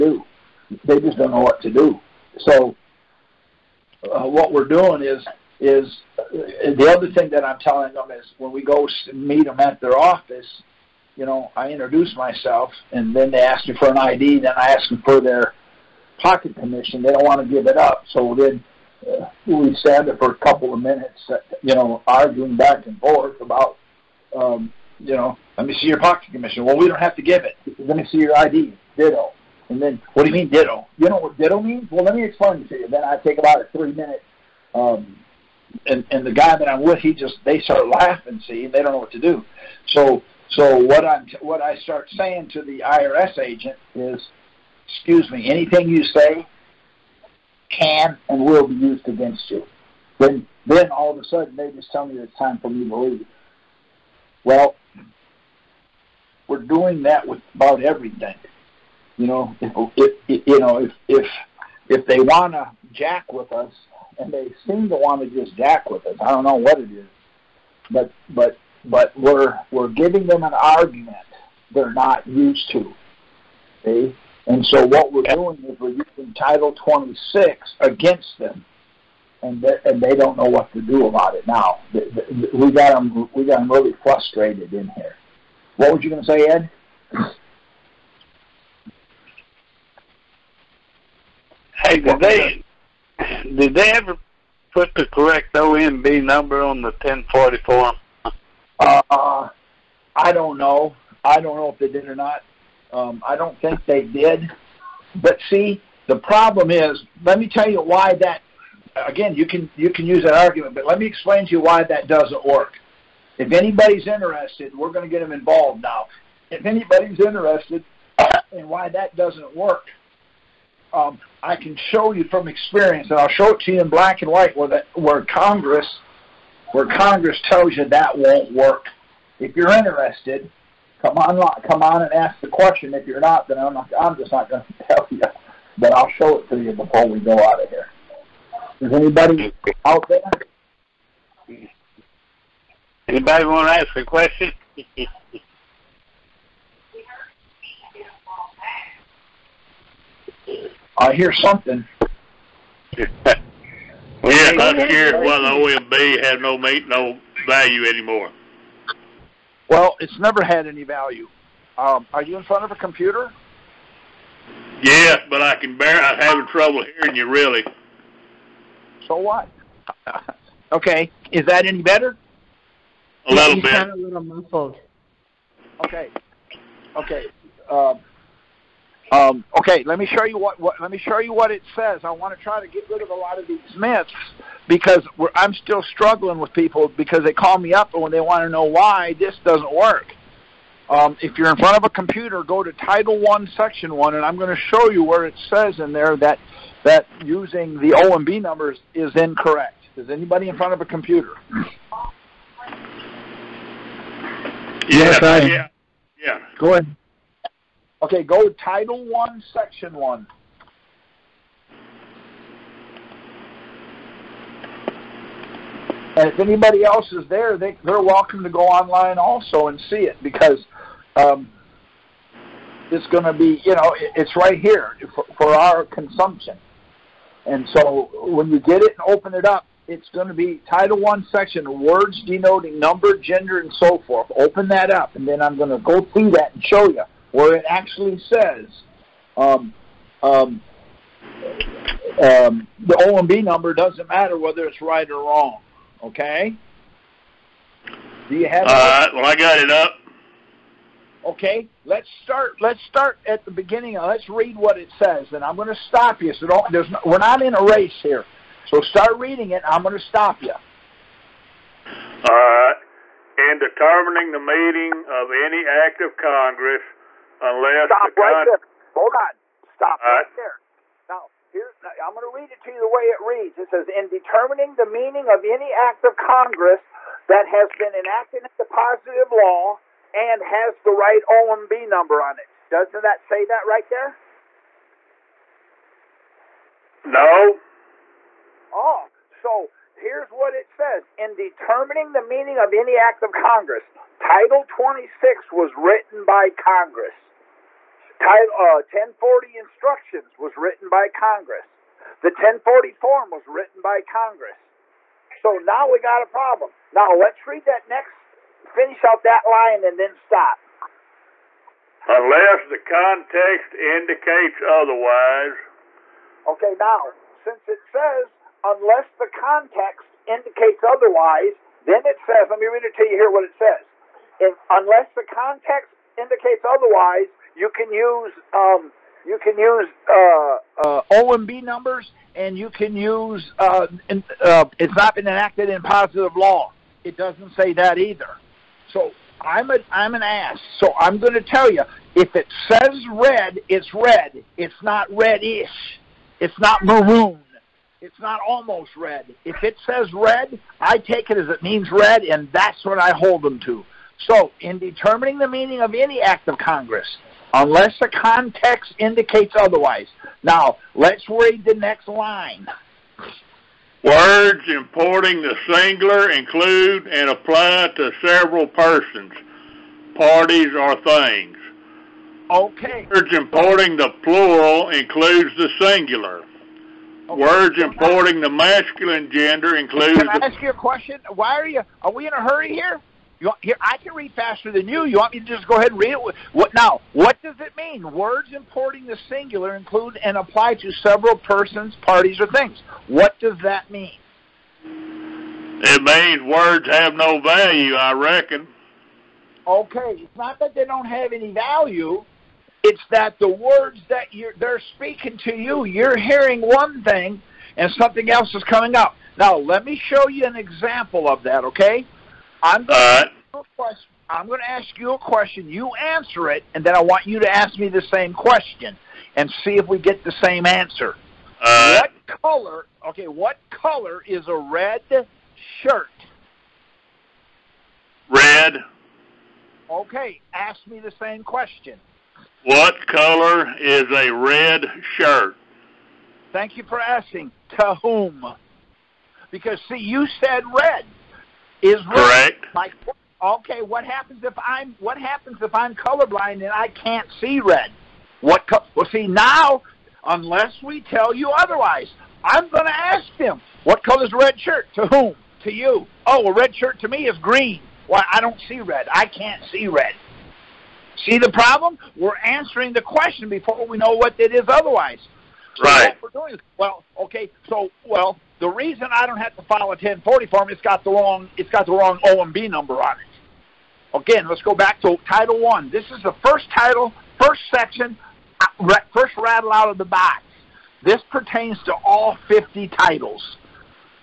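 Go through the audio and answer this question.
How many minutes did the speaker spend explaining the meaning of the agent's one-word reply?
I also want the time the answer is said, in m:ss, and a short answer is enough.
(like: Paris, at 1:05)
3 minutes, at 0:33.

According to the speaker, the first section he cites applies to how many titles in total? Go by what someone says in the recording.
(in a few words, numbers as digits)
50.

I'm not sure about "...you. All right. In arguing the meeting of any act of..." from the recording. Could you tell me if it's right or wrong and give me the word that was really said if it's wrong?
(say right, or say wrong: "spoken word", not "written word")
wrong: "determining", not "arguing".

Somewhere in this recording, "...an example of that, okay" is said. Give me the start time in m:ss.
6:50.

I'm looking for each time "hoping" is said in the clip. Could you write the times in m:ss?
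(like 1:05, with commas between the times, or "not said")
not said.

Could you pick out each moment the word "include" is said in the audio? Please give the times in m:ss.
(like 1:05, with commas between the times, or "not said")
6:06, 6:14, 6:19, 6:29.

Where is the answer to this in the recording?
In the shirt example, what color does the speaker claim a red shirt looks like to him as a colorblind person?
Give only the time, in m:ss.
7:37.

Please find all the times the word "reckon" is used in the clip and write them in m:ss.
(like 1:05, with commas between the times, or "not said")
6:38.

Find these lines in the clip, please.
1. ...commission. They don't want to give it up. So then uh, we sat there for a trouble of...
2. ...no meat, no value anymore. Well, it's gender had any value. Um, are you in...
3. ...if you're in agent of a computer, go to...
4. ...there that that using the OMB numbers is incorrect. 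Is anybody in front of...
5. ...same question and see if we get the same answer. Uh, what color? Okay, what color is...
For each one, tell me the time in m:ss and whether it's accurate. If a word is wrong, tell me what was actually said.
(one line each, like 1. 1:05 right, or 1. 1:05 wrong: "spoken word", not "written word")
1. 0:16 wrong: "couple", not "trouble"
2. 2:36 wrong: "never", not "gender"
3. 3:11 wrong: "front", not "agent"
4. 3:15 right
5. 6:58 right.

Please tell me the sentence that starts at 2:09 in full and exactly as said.
If you're interested, come on, come on and ask the question.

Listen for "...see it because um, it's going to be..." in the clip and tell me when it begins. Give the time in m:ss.
3:39.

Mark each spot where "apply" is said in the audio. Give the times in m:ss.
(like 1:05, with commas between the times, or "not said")
6:07, 6:30.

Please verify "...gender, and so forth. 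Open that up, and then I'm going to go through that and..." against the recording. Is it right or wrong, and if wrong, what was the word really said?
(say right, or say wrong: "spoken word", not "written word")
right.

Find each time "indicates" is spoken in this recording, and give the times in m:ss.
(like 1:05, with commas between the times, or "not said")
5:13, 5:20, 5:26, 5:58.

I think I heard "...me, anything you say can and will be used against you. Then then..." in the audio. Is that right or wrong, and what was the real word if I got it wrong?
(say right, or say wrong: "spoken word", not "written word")
right.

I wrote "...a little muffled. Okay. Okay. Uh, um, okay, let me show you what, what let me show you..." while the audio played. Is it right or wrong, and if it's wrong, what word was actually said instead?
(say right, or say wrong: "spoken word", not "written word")
right.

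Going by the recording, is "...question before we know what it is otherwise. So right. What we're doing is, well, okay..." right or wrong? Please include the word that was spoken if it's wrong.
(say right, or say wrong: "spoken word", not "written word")
right.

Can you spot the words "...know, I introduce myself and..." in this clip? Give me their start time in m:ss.
0:11.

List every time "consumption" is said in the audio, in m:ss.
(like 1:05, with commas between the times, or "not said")
3:45.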